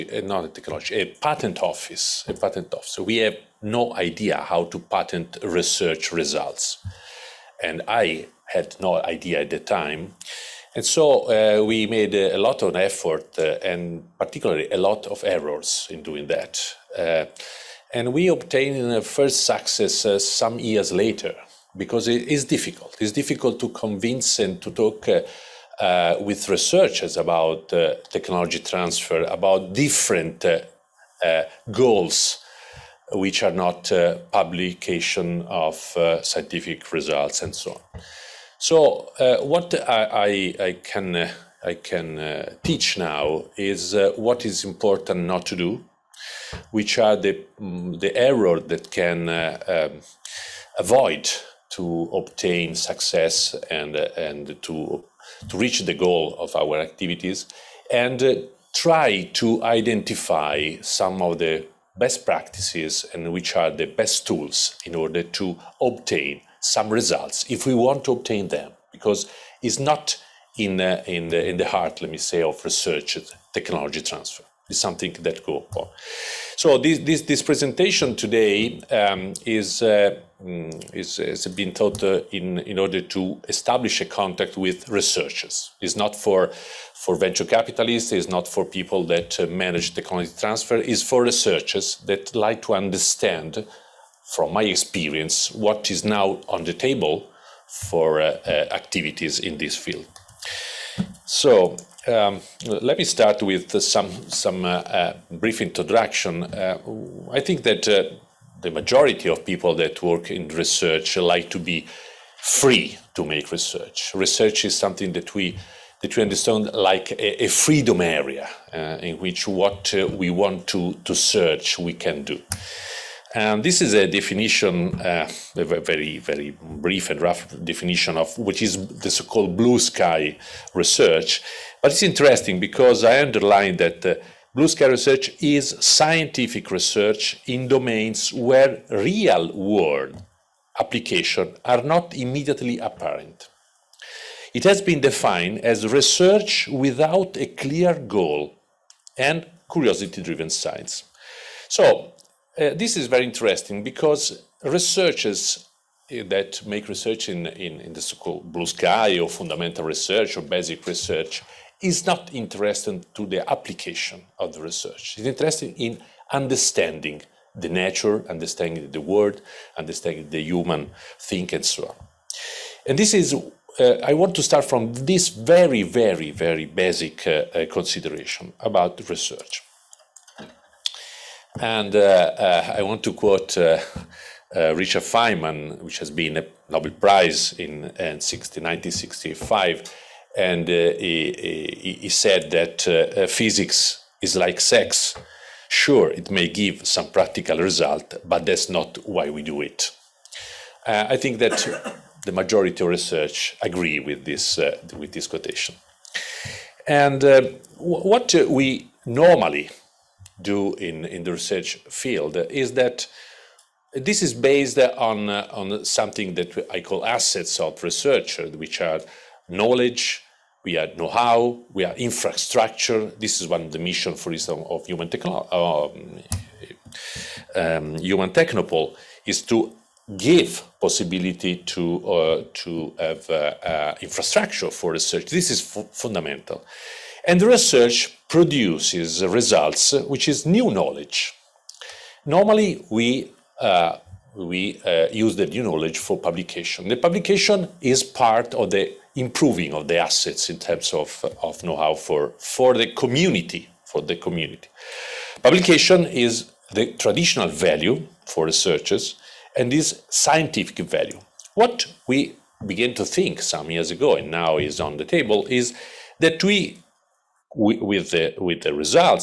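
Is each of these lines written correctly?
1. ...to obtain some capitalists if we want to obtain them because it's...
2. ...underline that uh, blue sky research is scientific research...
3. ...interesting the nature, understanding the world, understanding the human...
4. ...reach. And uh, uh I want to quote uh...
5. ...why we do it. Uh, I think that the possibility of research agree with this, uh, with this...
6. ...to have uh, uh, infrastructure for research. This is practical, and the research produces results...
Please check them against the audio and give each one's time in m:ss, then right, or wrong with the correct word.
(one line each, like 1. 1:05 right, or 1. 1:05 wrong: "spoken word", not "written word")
1. 1:05 wrong: "results", not "capitalists"
2. 2:13 right
3. 2:46 wrong: "understanding", not "interesting"
4. 2:59 wrong: "research", not "reach"
5. 3:19 wrong: "majority", not "possibility"
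6. 3:52 wrong: "fundamental", not "practical".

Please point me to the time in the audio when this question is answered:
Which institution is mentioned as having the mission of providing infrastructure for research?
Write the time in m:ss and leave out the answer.
3:47.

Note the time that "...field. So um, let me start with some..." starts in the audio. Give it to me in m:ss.
1:39.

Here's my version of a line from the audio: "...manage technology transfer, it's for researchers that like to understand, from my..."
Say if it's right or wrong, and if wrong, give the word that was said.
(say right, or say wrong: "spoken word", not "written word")
right.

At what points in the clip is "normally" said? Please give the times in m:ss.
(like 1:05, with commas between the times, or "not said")
3:29, 4:02.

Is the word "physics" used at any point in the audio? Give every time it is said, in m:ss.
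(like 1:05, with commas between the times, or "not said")
3:13.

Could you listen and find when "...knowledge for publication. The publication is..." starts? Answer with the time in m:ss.
4:05.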